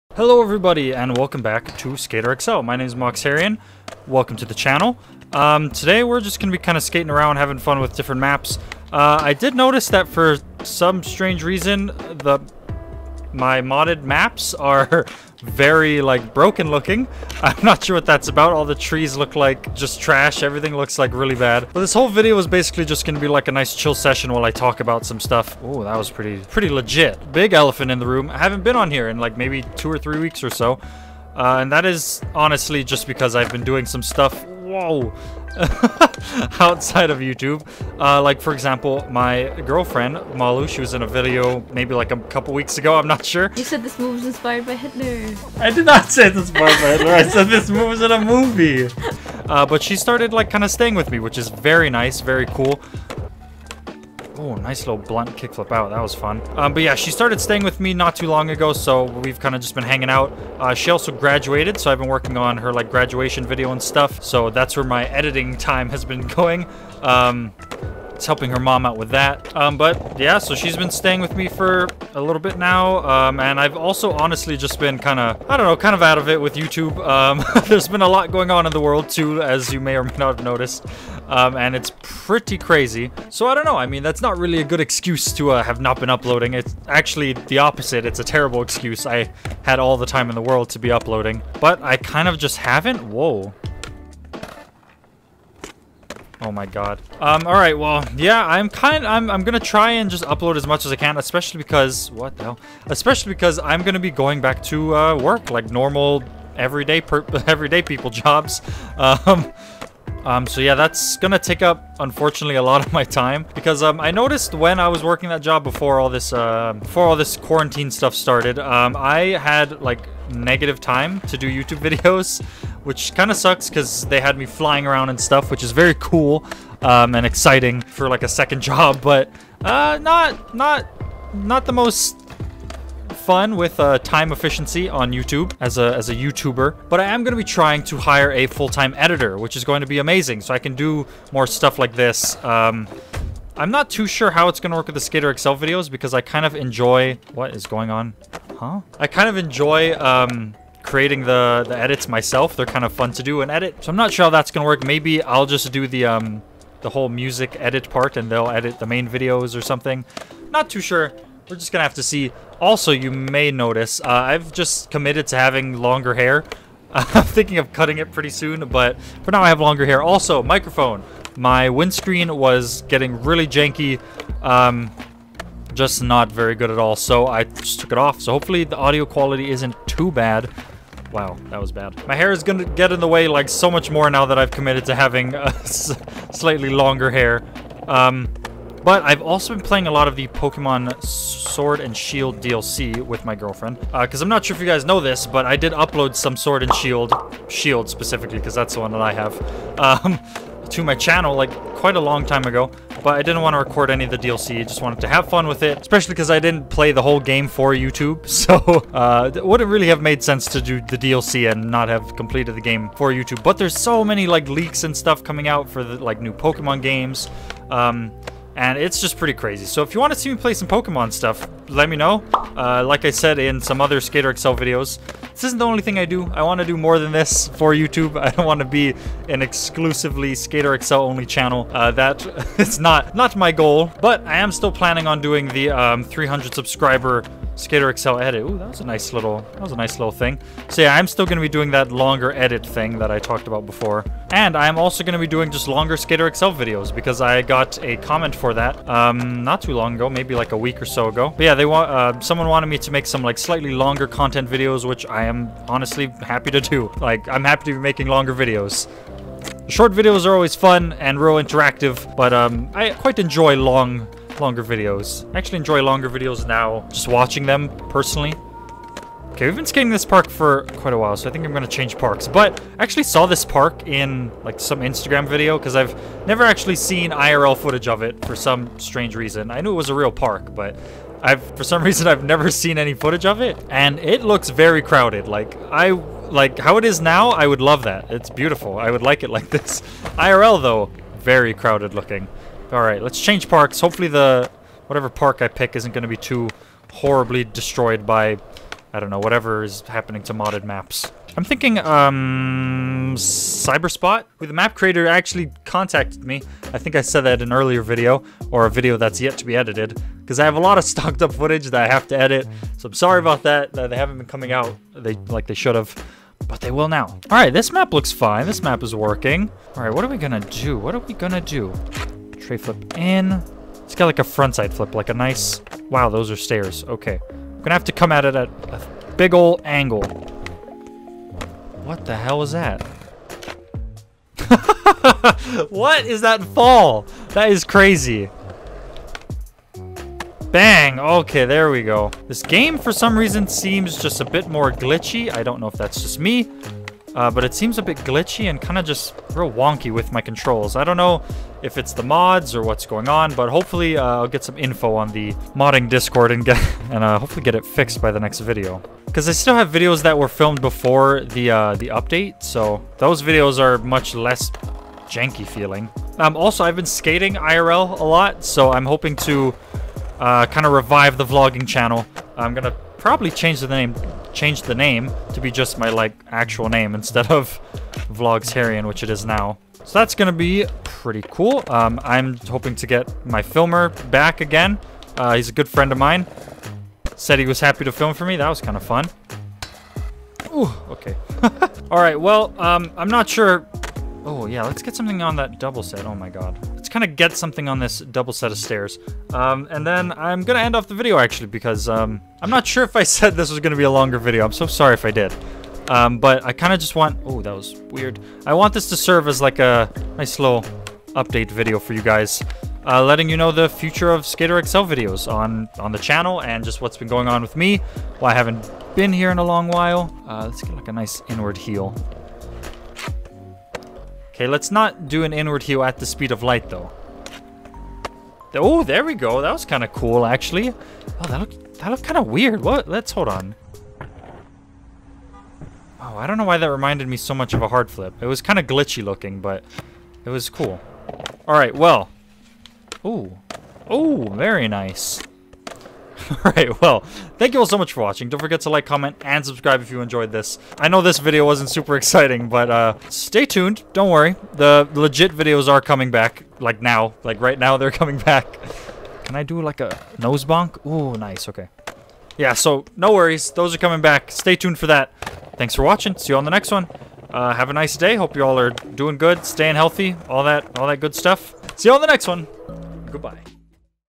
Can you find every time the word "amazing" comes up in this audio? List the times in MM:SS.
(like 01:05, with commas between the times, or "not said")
02:19.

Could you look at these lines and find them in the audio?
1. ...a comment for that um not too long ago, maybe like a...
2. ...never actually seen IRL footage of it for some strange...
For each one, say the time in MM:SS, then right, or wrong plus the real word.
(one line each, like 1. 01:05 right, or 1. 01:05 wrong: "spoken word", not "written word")
1. 04:07 right
2. 04:36 right.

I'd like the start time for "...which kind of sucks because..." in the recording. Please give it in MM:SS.
02:02.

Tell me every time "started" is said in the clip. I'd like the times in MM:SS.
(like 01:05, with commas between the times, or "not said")
00:49, 00:57, 01:58.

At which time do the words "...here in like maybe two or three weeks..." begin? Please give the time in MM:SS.
00:28.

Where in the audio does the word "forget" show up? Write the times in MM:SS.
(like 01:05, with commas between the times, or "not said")
07:28.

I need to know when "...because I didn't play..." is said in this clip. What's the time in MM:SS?
03:26.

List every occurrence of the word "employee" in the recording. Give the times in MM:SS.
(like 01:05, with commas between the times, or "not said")
not said.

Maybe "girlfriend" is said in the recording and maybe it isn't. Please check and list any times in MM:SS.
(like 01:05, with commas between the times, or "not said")
00:39, 03:13.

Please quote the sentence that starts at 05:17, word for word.
All right, this map looks fine.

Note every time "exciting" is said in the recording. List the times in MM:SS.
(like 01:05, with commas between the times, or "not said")
02:07, 07:31.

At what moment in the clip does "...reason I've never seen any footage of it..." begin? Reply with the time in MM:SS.
04:41.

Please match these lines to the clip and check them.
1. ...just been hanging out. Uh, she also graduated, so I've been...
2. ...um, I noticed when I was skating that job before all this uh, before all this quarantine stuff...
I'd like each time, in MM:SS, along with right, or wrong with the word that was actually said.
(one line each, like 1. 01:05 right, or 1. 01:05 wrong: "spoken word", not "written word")
1. 00:59 right
2. 01:53 wrong: "working", not "skating".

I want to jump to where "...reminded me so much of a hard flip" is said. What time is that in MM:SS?
07:16.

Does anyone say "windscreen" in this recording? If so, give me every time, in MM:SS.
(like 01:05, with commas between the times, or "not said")
02:51.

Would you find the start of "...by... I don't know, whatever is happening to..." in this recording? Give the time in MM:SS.
04:58.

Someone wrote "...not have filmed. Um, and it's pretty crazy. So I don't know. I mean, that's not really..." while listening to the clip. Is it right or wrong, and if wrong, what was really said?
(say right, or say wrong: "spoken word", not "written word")
wrong: "noticed", not "filmed".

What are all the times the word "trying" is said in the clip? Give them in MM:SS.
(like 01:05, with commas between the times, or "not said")
02:17.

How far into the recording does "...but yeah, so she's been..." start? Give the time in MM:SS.
01:09.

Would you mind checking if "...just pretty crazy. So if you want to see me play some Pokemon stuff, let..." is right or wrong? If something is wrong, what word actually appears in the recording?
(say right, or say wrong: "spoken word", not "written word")
right.